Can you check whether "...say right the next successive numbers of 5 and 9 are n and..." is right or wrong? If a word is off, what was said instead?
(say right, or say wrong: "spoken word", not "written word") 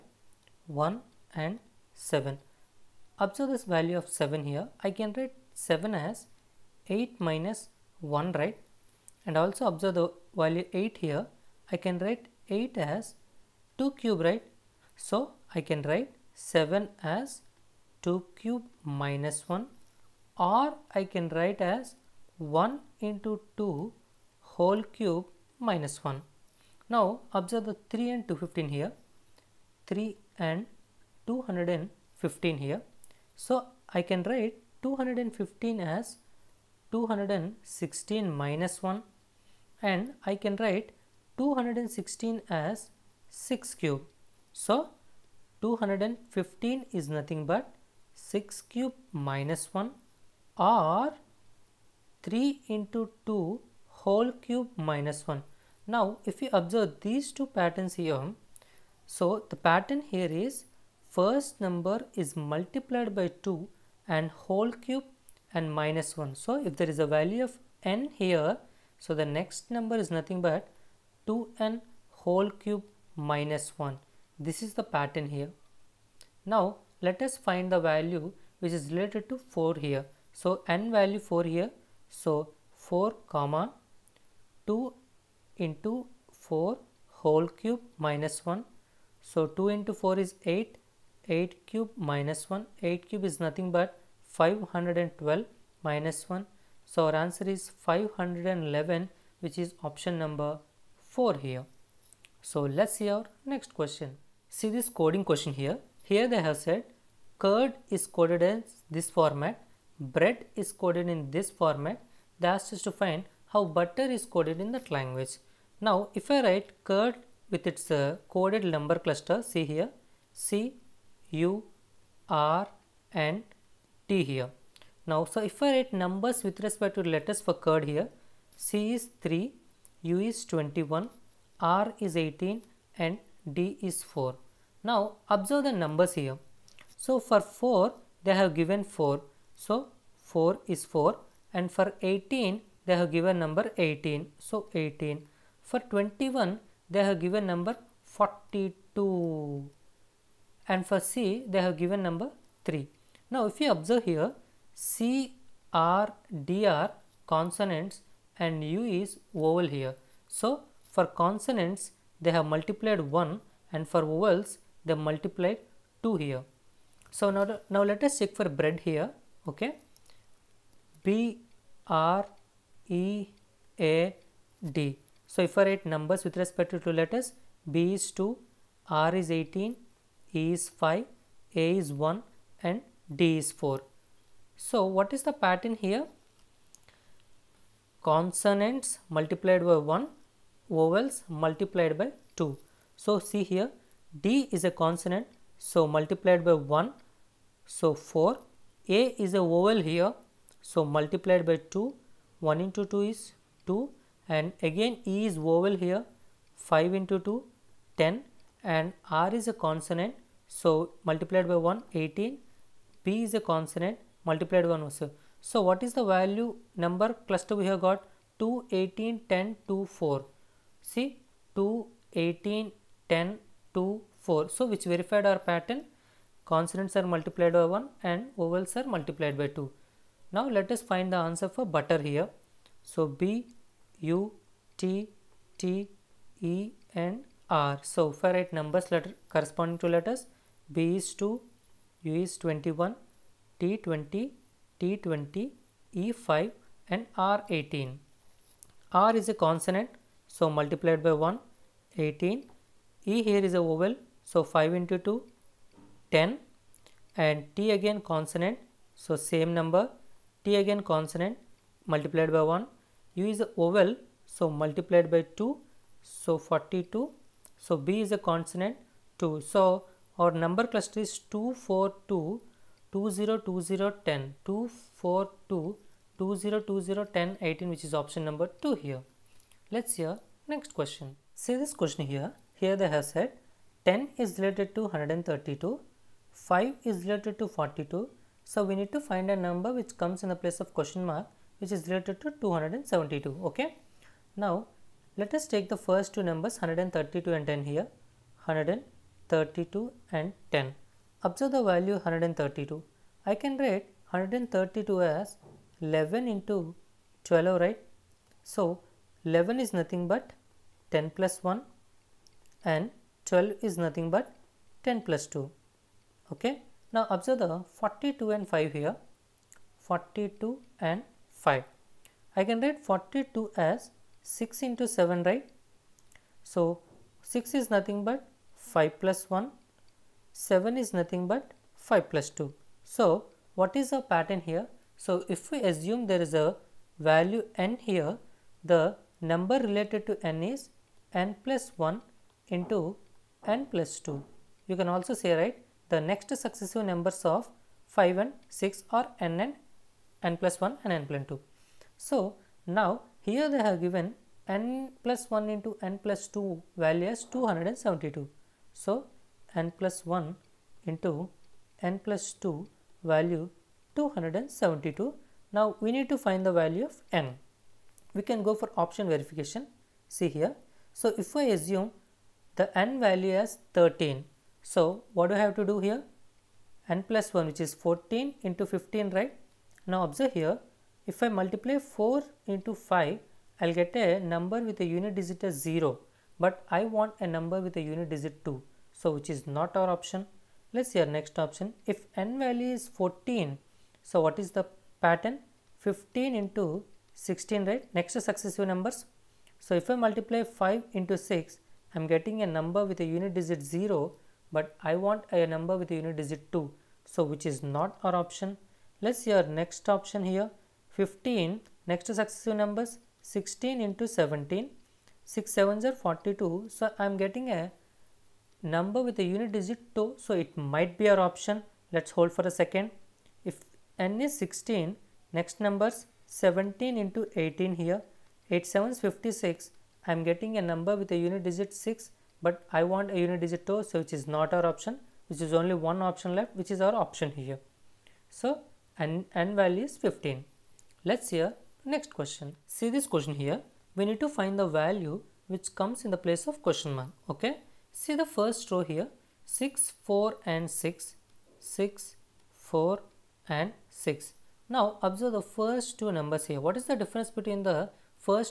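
wrong: "6", not "9".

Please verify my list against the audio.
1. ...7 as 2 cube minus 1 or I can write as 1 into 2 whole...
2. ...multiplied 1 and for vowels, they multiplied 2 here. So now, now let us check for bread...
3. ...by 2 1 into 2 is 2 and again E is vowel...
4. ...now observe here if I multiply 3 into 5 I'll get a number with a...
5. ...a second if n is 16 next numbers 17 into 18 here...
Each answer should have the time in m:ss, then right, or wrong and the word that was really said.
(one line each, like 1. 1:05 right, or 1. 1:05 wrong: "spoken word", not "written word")
1. 0:16 right
2. 2:42 right
3. 3:21 right
4. 6:19 wrong: "4", not "3"
5. 7:02 right.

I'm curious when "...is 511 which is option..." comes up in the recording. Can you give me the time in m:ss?
1:37.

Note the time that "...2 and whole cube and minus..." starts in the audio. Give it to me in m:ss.
1:03.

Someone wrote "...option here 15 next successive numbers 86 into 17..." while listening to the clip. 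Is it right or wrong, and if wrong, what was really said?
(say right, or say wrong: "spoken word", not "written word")
wrong: "16", not "86".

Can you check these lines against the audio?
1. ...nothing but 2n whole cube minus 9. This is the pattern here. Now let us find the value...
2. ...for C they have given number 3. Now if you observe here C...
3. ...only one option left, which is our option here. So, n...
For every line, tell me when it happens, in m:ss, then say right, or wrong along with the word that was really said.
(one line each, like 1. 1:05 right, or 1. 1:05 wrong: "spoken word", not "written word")
1. 1:10 wrong: "1", not "9"
2. 2:30 right
3. 7:15 right.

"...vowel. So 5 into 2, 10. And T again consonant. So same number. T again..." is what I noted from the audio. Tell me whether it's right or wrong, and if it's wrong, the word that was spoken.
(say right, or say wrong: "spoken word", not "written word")
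right.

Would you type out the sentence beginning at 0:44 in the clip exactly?
So 215 is nothing but 6 cube minus 1 or 3 into 2 whole cube minus 1.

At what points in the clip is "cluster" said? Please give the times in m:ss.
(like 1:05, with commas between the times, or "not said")
1:59, 3:37, 4:30.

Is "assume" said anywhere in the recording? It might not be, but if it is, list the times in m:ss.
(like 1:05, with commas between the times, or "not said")
5:35, 6:11.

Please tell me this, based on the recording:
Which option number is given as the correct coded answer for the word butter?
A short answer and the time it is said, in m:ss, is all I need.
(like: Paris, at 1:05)
2, at 4:37.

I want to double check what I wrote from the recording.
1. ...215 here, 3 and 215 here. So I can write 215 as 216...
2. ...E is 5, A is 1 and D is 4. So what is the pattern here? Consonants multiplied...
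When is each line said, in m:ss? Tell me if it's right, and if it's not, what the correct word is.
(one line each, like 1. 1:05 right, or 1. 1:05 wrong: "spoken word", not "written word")
1. 0:28 right
2. 3:00 right.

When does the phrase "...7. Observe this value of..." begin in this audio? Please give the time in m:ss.
0:01.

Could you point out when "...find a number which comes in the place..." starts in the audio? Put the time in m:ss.
4:49.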